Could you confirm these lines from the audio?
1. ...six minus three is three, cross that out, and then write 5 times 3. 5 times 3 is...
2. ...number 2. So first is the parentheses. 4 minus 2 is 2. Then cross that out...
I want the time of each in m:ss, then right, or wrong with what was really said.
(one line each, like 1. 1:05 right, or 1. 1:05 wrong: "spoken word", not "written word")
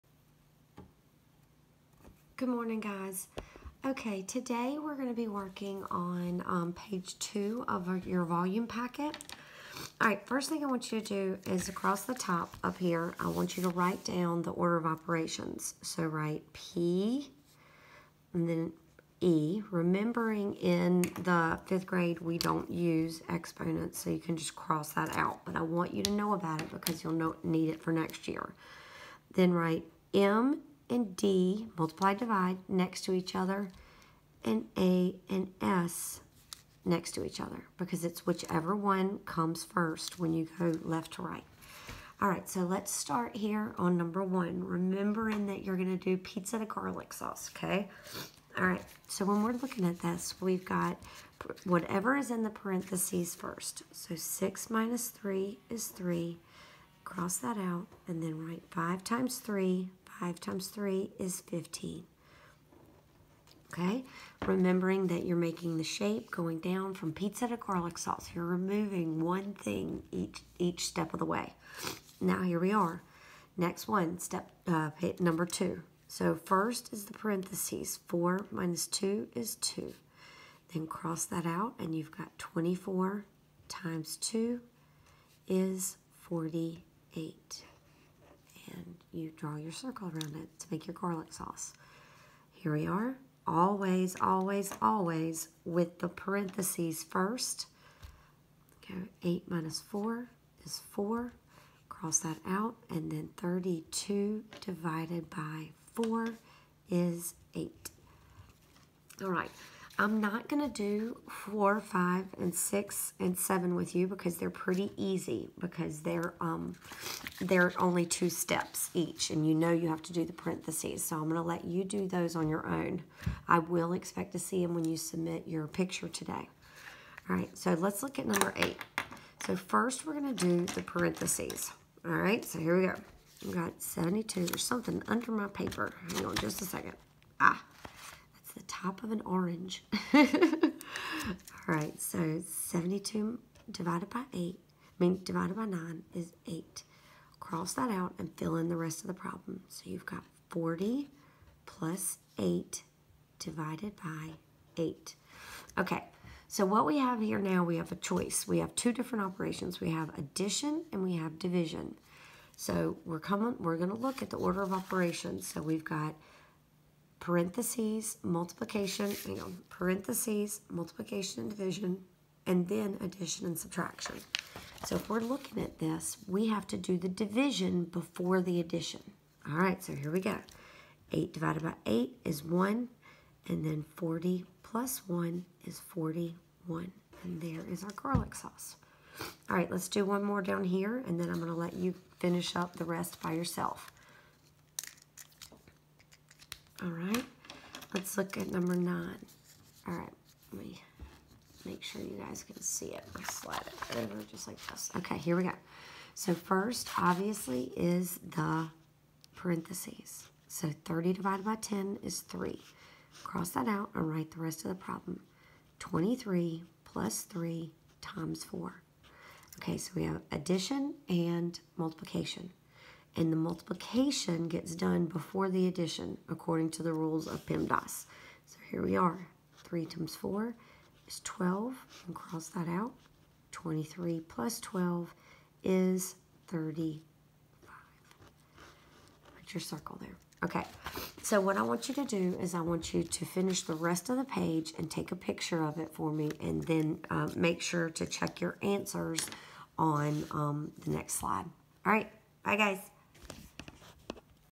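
1. 0:54 right
2. 1:15 right.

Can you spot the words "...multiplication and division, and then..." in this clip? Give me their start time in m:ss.
2:50.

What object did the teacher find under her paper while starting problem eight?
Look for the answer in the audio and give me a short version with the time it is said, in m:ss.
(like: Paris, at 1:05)
The top of an orange, at 2:18.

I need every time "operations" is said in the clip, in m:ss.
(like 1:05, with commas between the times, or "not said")
0:14, 2:39, 2:44.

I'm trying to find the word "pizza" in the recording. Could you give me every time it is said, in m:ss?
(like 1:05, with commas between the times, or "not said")
0:46, 1:07.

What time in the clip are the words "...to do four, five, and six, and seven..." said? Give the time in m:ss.
1:50.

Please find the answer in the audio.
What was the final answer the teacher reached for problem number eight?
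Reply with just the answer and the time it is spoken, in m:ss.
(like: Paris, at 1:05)
41, at 3:05.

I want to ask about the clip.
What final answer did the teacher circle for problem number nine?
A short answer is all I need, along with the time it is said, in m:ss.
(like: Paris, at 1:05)
35, at 3:56.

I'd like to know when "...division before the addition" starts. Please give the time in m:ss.
2:57.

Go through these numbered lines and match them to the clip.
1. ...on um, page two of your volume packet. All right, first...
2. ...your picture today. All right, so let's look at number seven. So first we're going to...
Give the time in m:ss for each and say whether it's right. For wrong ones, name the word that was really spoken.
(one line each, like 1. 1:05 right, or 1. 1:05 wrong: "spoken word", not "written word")
1. 0:05 right
2. 2:05 wrong: "eight", not "seven".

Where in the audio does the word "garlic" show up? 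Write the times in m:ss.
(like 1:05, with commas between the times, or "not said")
0:46, 1:07, 1:30, 3:07.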